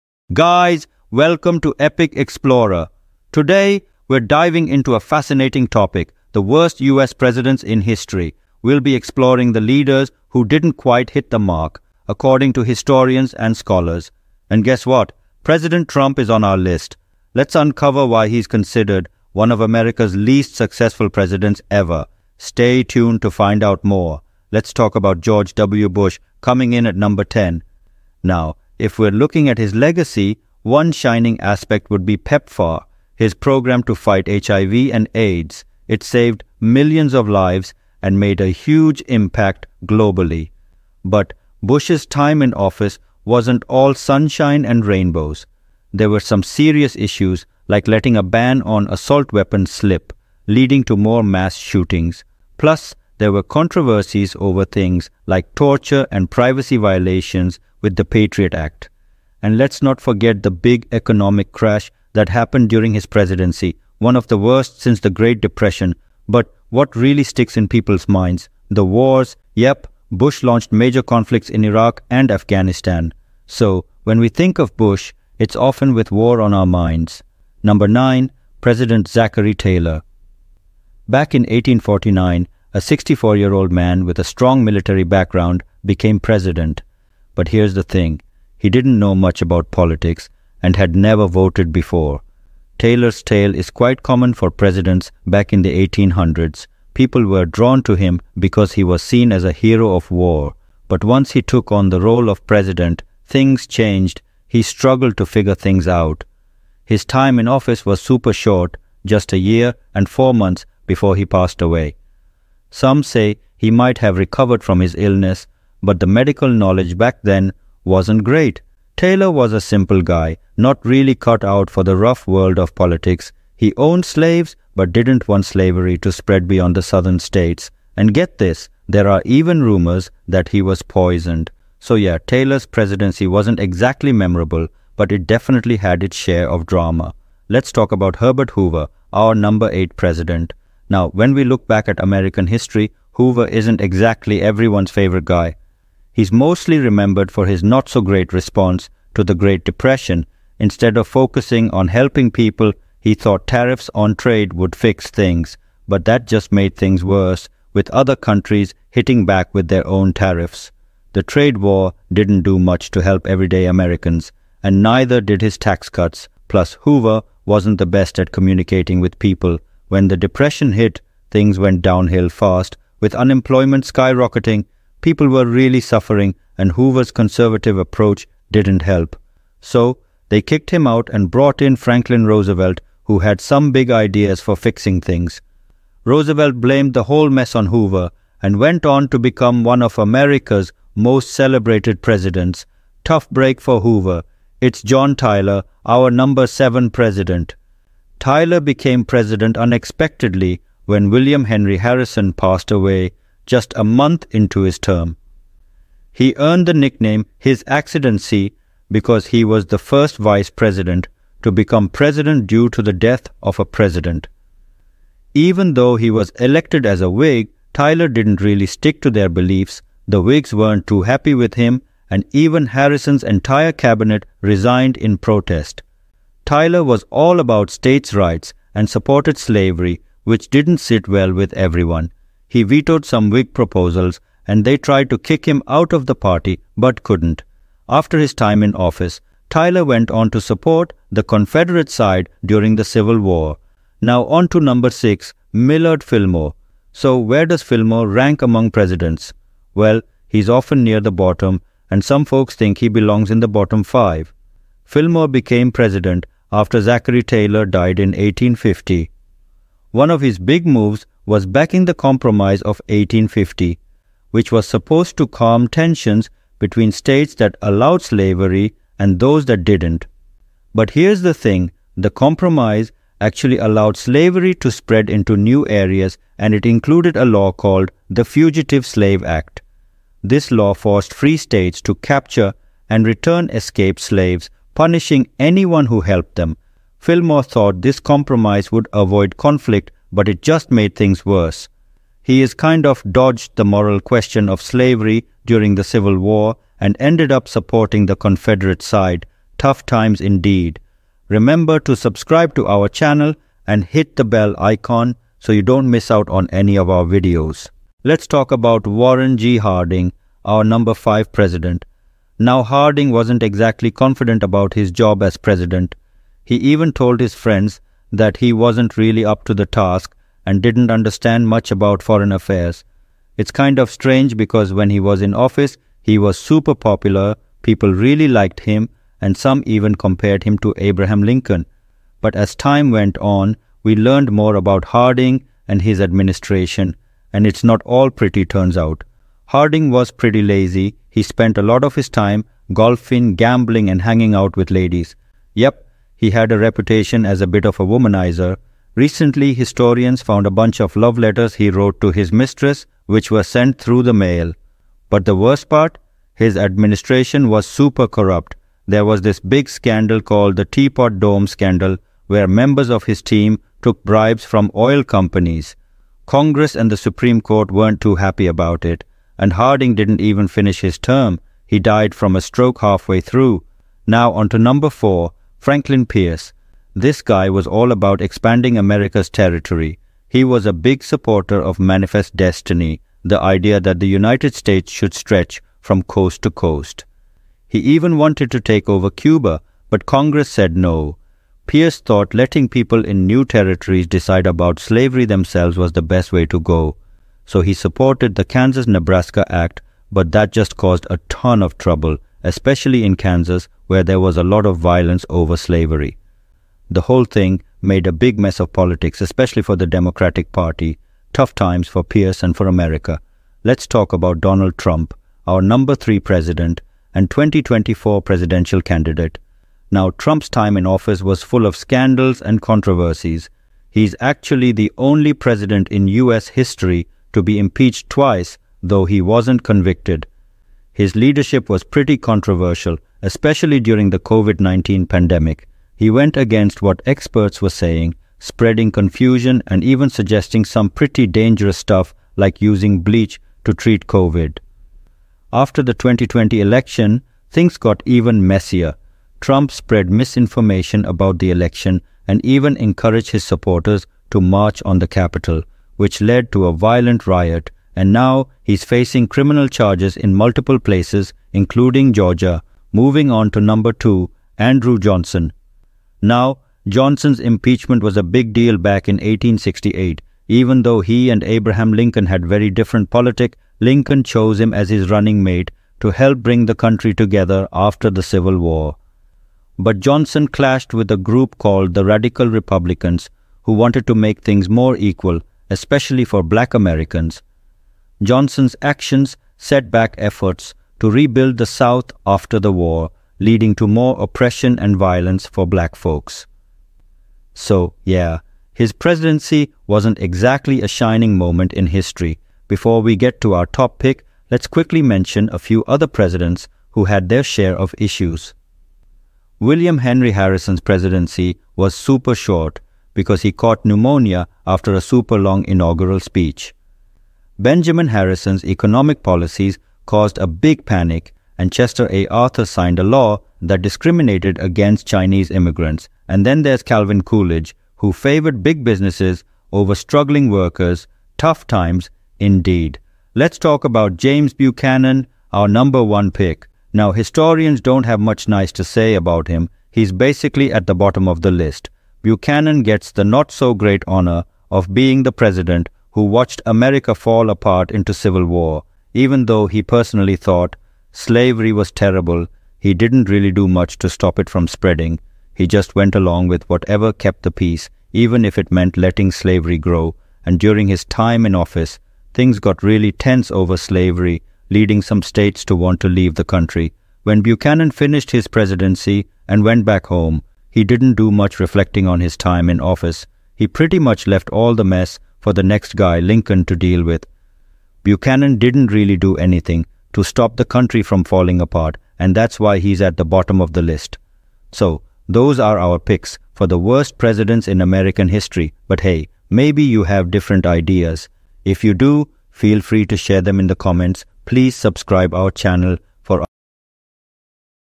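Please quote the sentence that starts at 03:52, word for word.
He vetoed some Whig proposals, and they tried to kick him out of the party but couldn't.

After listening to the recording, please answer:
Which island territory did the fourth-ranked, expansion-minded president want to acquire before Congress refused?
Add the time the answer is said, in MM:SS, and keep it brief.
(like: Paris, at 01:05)
Cuba, at 06:29.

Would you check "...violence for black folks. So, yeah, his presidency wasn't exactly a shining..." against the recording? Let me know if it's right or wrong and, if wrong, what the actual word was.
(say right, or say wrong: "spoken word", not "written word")
right.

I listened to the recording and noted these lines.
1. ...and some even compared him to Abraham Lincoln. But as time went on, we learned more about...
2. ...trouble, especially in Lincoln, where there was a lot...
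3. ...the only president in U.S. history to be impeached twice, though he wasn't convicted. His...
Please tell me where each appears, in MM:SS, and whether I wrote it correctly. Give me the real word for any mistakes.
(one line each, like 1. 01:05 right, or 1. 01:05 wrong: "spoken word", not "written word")
1. 05:29 right
2. 06:41 wrong: "Kansas", not "Lincoln"
3. 07:04 right.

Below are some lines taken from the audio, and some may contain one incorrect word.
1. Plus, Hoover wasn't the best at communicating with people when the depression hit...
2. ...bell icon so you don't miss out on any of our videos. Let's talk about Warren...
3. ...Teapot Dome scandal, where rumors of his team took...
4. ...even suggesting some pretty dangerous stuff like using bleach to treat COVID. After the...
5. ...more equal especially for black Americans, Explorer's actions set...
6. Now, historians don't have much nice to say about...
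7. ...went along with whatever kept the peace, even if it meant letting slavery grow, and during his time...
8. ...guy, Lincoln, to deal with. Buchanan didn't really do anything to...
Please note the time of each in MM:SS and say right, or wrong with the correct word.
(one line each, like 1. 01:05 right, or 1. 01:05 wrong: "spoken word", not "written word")
1. 02:46 right
2. 05:04 right
3. 06:00 wrong: "members", not "rumors"
4. 07:19 right
5. 08:04 wrong: "Johnson", not "Explorer"
6. 08:56 right
7. 09:15 right
8. 09:35 right.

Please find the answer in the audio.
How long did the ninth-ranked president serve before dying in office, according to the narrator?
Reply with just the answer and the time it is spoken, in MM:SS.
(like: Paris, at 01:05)
1 year and 4 months, at 01:49.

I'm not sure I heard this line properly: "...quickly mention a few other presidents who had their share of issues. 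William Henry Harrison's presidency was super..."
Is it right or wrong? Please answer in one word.
right.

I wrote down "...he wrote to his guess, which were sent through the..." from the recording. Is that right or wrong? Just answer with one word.
wrong.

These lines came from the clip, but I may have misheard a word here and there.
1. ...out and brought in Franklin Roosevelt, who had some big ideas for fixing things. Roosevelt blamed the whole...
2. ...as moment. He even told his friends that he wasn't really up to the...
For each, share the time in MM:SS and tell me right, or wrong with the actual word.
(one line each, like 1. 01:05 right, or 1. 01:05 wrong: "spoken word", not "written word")
1. 03:00 right
2. 05:15 wrong: "president", not "moment".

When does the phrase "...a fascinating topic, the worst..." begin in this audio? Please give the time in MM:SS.
00:04.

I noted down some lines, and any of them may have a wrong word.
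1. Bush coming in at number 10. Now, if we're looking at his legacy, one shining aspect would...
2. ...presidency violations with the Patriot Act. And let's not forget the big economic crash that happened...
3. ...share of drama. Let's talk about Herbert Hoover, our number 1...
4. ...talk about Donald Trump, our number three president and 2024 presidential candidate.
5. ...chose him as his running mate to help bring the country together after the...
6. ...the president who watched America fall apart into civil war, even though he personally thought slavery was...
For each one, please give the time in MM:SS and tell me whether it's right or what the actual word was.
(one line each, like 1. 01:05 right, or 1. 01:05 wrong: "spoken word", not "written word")
1. 00:25 right
2. 00:56 wrong: "privacy", not "presidency"
3. 02:16 wrong: "8", not "1"
4. 06:53 right
5. 07:54 right
6. 09:05 right.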